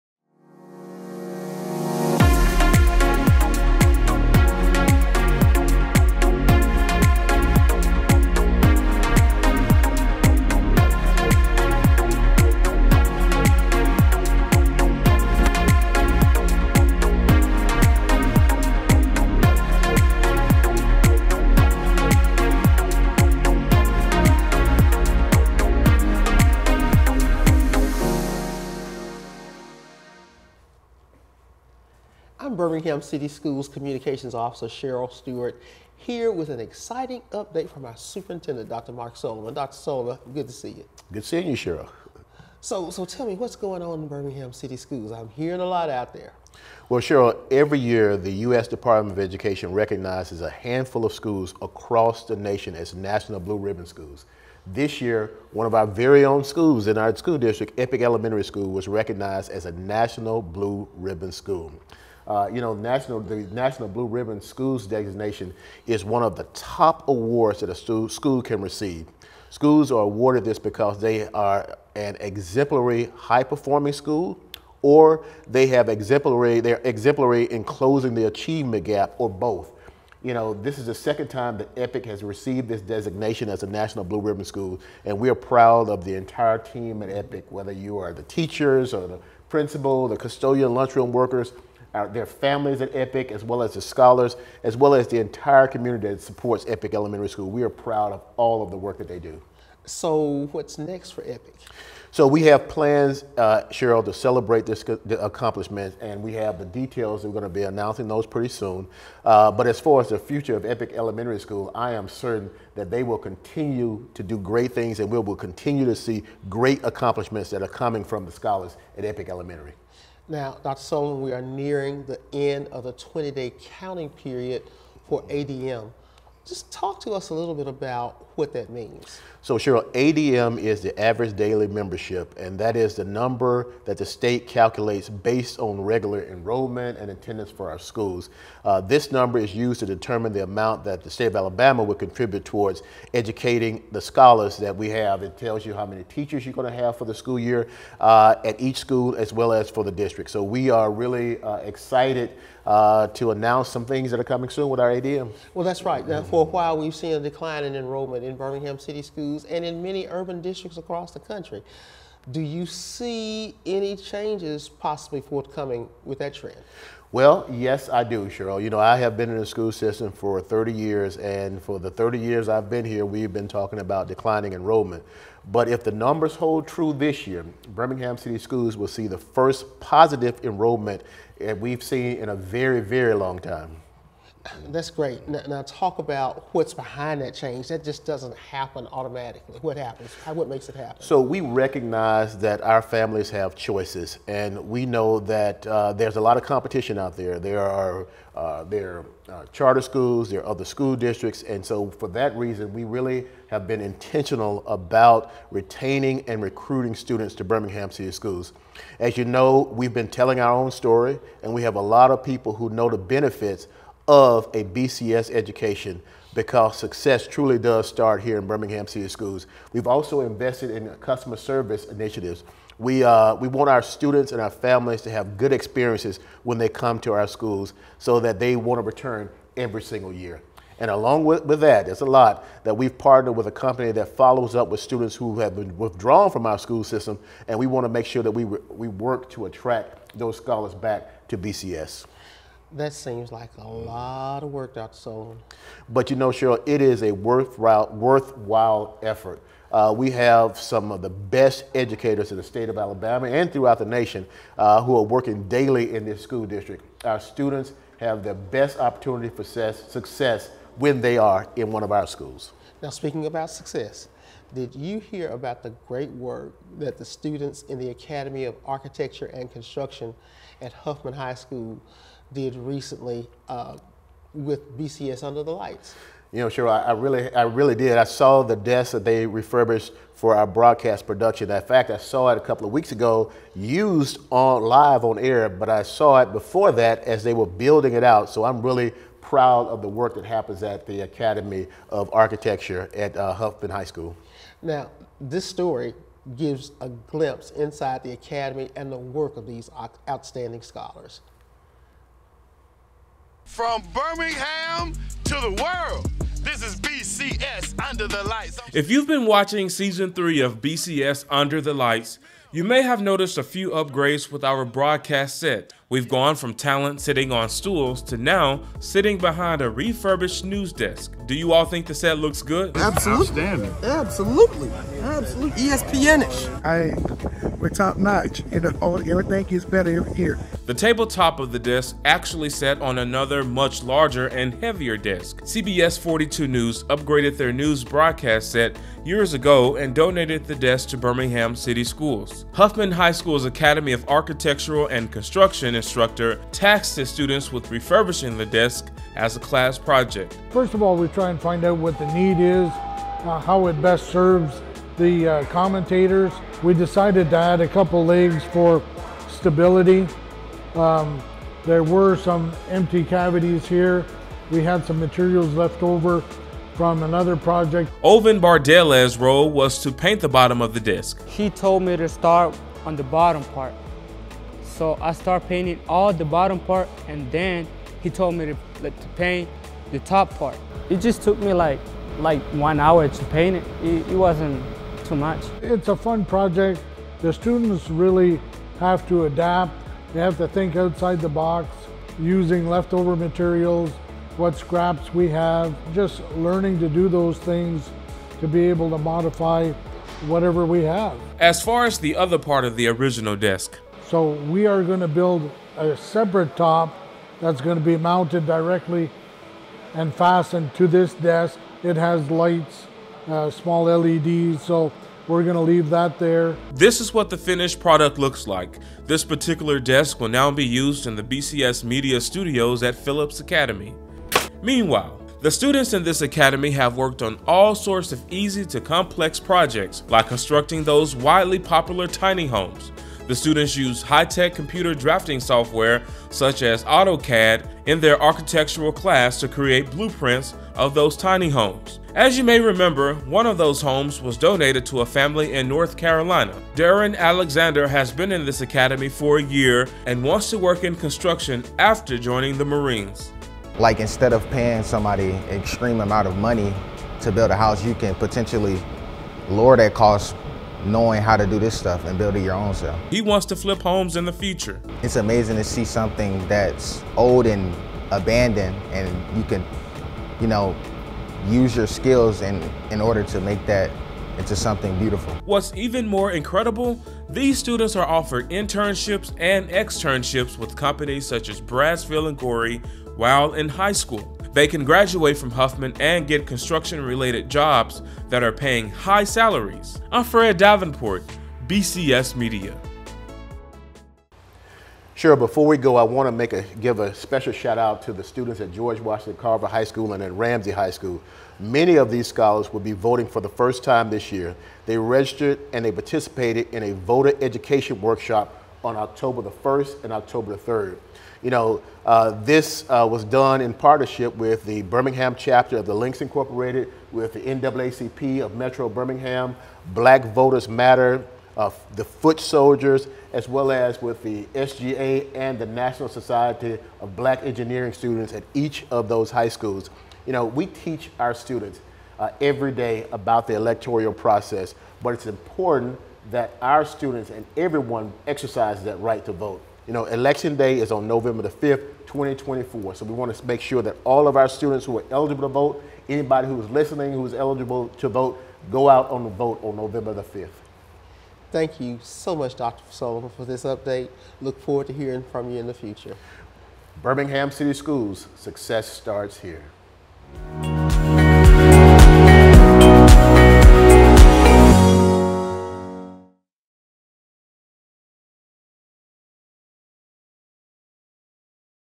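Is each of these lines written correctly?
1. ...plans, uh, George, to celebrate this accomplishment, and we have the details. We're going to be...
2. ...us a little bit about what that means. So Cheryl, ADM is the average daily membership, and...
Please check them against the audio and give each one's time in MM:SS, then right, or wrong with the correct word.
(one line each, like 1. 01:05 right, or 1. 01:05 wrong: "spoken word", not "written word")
1. 01:42 wrong: "Cheryl", not "George"
2. 02:07 right.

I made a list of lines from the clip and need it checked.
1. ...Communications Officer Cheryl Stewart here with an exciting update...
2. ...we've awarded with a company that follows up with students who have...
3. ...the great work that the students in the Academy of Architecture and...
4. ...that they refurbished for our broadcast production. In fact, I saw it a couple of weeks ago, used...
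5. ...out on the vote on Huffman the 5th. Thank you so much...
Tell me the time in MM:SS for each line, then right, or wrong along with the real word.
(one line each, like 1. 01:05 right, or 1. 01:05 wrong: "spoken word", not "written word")
1. 00:33 right
2. 03:52 wrong: "partnered", not "awarded"
3. 04:25 right
4. 04:38 right
5. 09:08 wrong: "November", not "Huffman".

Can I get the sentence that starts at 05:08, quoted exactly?
If you've been watching season three of BCS Under the Lights, you may have noticed a few upgrades with our broadcast set.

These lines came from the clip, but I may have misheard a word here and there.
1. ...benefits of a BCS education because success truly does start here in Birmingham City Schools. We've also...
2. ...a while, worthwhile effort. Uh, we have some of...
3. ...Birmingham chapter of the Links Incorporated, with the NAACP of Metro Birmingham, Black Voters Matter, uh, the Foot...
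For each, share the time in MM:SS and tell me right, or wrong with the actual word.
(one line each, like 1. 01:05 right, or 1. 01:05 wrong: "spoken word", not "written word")
1. 03:32 right
2. 04:07 wrong: "worthwhile", not "while"
3. 08:34 right.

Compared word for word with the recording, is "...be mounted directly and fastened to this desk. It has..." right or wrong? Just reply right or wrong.
right.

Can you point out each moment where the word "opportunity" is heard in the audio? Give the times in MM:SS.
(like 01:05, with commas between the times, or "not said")
04:18.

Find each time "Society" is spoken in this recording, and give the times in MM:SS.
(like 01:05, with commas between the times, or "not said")
08:46.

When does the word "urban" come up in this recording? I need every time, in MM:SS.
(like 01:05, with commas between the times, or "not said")
02:40.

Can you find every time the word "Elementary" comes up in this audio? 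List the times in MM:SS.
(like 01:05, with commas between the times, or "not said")
00:58, 01:36, 01:50, 01:59.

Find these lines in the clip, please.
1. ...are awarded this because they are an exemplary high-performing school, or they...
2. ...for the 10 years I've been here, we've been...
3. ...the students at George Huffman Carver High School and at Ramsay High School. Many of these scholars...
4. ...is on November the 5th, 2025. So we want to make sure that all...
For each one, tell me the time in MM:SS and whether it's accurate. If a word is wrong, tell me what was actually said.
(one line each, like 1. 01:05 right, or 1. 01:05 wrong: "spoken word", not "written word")
1. 01:09 right
2. 02:51 wrong: "30", not "10"
3. 08:18 wrong: "Washington", not "Huffman"
4. 09:00 wrong: "2024", not "2025".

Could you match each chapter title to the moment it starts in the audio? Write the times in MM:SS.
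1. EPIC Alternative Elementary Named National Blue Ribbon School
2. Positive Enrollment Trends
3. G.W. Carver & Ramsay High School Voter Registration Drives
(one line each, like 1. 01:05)
1. 00:47
2. 02:00
3. 08:14.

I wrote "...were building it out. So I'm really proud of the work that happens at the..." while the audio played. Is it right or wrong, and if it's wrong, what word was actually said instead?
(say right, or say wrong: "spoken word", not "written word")
right.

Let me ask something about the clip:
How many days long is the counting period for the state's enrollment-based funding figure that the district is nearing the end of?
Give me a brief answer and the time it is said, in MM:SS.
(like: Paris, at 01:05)
20, at 02:02.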